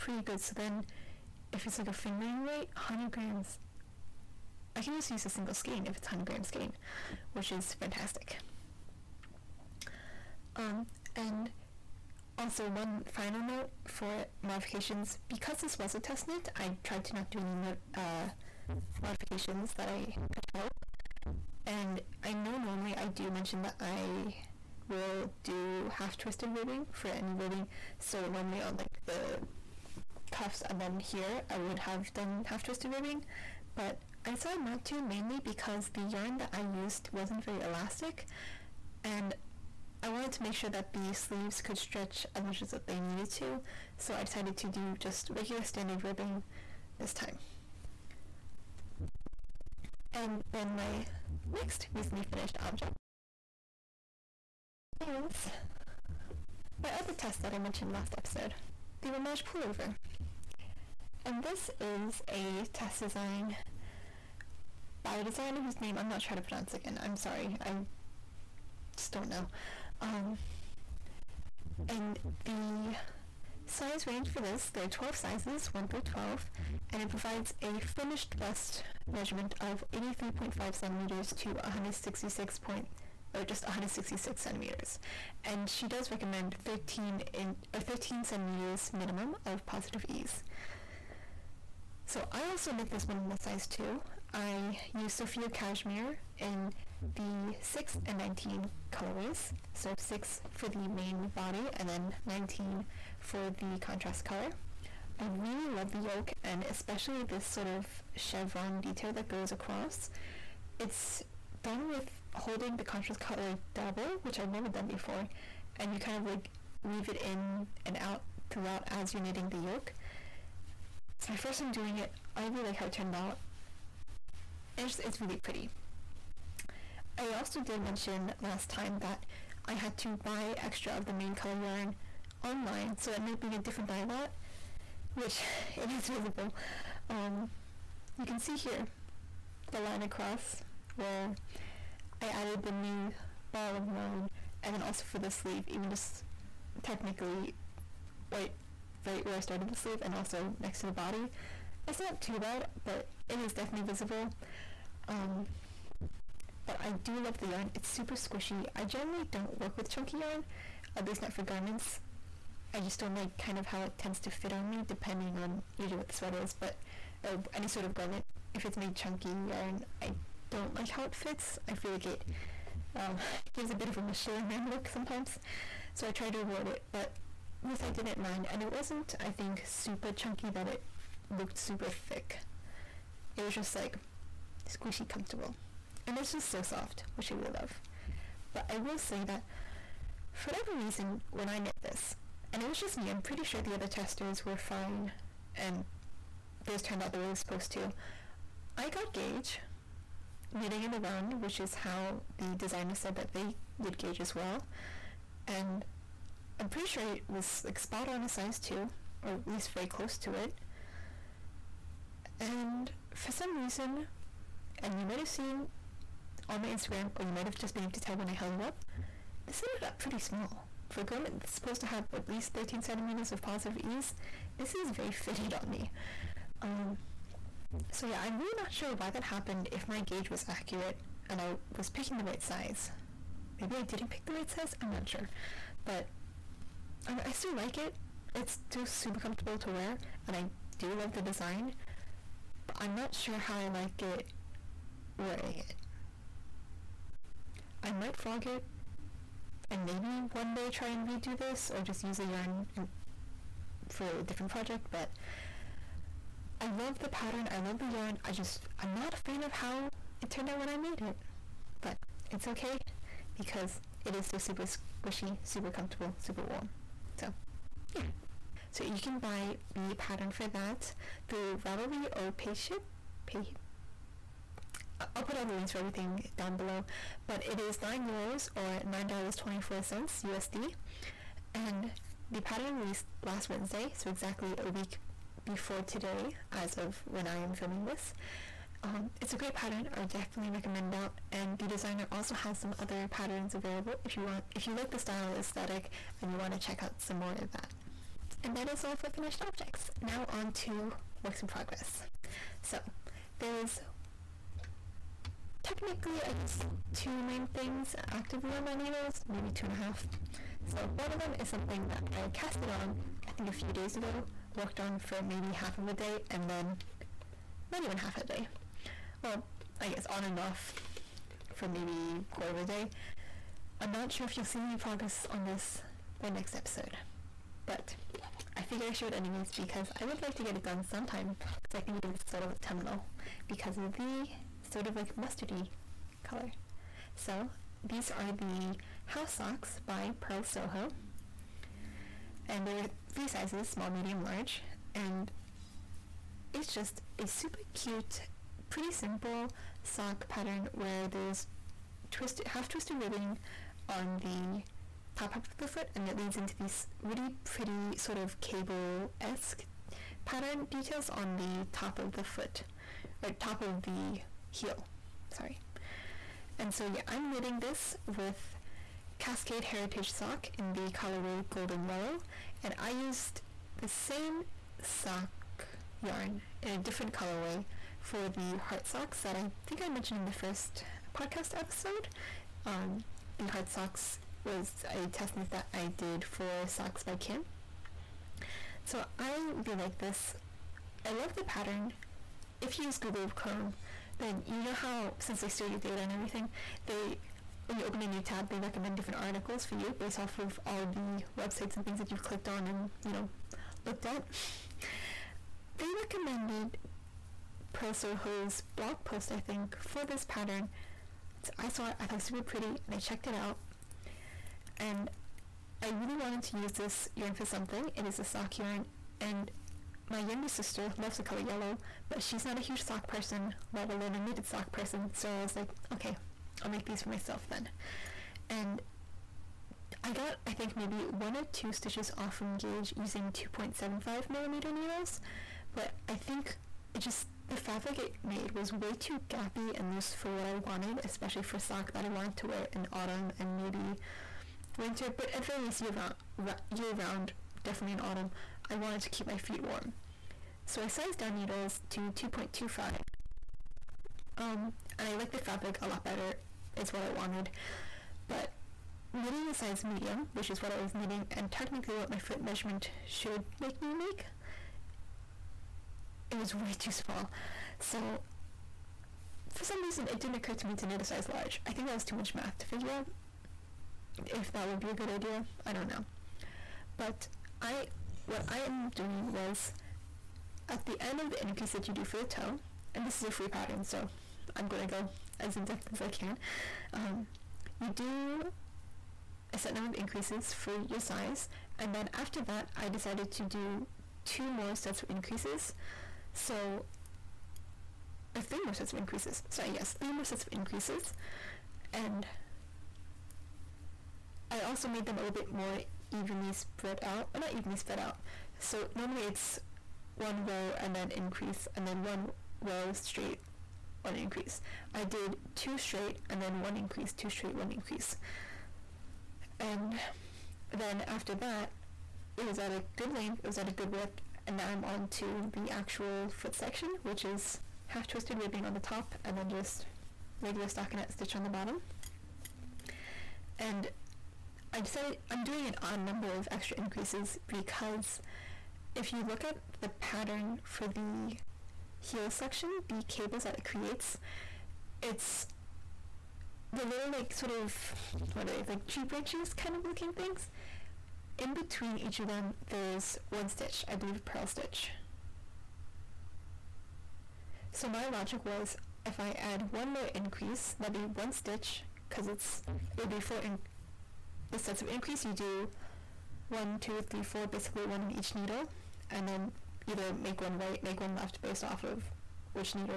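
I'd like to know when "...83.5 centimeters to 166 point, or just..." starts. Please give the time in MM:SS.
01:19.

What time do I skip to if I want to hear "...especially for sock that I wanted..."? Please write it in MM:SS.
07:21.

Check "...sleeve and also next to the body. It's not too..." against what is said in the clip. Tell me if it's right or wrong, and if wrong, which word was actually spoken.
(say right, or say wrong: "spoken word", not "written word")
right.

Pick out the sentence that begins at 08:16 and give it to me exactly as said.
So, or three more sets of increases.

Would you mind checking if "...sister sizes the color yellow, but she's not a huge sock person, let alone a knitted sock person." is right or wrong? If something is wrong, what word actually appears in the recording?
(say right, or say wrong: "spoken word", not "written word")
wrong: "loves", not "sizes".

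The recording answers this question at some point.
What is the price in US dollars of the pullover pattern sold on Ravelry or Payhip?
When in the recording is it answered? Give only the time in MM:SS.
04:38.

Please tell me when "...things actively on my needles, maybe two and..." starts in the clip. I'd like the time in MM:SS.
05:07.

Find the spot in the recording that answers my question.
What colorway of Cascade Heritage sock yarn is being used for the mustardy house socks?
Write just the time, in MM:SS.
06:11.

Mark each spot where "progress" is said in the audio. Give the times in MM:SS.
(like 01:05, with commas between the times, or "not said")
05:01, 05:24.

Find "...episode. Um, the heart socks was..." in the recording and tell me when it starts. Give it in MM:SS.
06:21.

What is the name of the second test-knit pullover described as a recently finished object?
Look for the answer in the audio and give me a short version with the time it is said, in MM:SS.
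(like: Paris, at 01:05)
Ramaj, at 00:59.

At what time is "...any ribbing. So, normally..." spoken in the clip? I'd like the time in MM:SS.
00:27.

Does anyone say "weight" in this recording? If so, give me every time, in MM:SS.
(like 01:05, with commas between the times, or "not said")
00:02.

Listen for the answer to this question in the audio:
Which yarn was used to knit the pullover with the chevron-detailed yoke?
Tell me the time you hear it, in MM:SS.
01:35.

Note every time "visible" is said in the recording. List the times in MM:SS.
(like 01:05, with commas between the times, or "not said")
02:16, 02:33.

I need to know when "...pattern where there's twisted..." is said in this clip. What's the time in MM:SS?
05:50.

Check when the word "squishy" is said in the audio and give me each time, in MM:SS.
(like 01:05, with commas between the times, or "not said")
02:38, 03:04, 04:25.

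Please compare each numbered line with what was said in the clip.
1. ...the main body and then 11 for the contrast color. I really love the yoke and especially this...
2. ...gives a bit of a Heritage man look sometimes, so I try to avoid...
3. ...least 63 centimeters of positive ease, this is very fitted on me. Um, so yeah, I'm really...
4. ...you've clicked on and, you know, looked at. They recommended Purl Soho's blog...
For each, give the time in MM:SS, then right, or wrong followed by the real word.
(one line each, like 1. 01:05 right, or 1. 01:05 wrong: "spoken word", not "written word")
1. 01:40 wrong: "19", not "11"
2. 02:53 wrong: "Michelin", not "Heritage"
3. 03:42 wrong: "13", not "63"
4. 06:42 right.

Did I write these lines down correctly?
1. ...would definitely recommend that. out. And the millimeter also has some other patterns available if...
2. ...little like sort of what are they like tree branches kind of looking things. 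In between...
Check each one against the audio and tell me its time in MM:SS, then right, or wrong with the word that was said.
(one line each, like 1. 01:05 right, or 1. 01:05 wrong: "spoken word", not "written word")
1. 04:50 wrong: "designer", not "millimeter"
2. 09:06 right.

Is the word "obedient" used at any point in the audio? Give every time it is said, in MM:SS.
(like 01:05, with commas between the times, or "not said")
not said.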